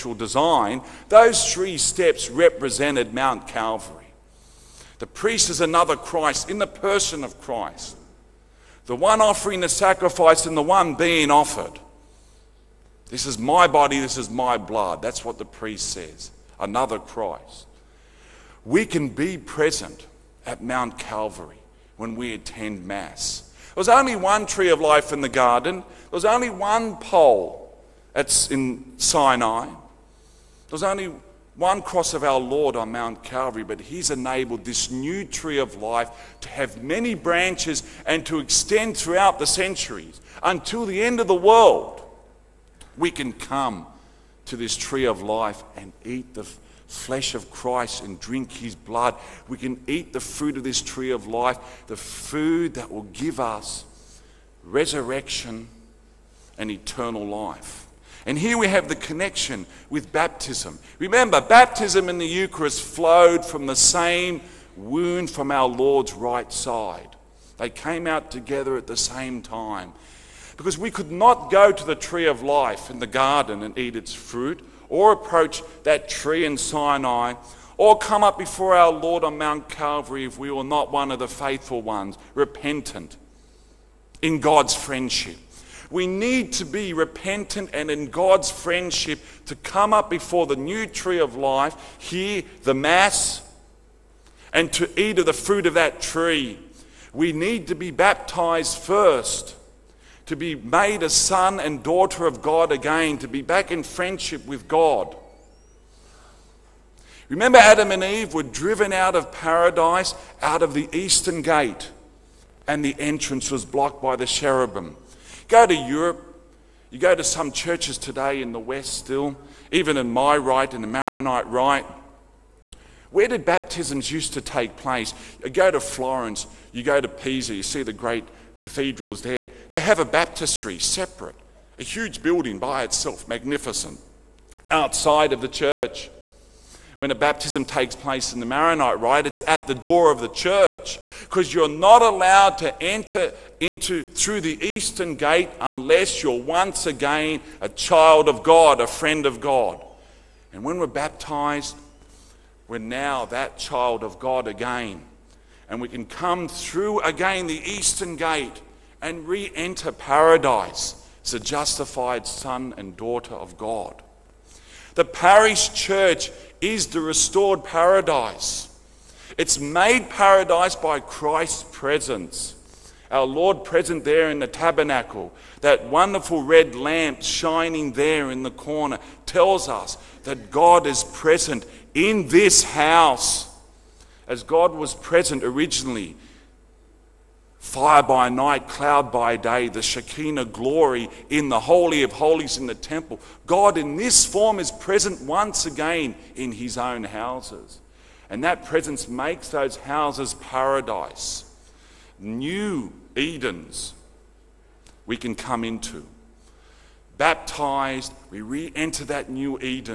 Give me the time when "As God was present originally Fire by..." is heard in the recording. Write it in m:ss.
3:04.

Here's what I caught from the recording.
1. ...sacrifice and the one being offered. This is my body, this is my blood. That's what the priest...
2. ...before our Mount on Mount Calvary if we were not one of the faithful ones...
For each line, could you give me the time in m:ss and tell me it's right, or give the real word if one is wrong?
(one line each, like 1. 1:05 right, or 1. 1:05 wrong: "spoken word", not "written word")
1. 0:09 right
2. 1:18 wrong: "Lord", not "Mount".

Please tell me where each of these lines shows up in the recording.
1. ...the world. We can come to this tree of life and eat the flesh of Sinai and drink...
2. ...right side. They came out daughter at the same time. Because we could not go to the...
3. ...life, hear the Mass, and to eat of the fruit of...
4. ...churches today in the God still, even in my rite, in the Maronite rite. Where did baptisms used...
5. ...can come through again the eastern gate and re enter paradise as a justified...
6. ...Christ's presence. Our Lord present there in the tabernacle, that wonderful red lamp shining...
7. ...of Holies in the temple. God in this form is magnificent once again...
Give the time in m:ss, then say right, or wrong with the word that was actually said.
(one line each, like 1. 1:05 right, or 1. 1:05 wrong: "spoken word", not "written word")
1. 0:41 wrong: "Christ", not "Sinai"
2. 1:06 wrong: "together", not "daughter"
3. 1:31 right
4. 1:57 wrong: "West", not "God"
5. 2:35 right
6. 2:50 right
7. 3:12 wrong: "present", not "magnificent".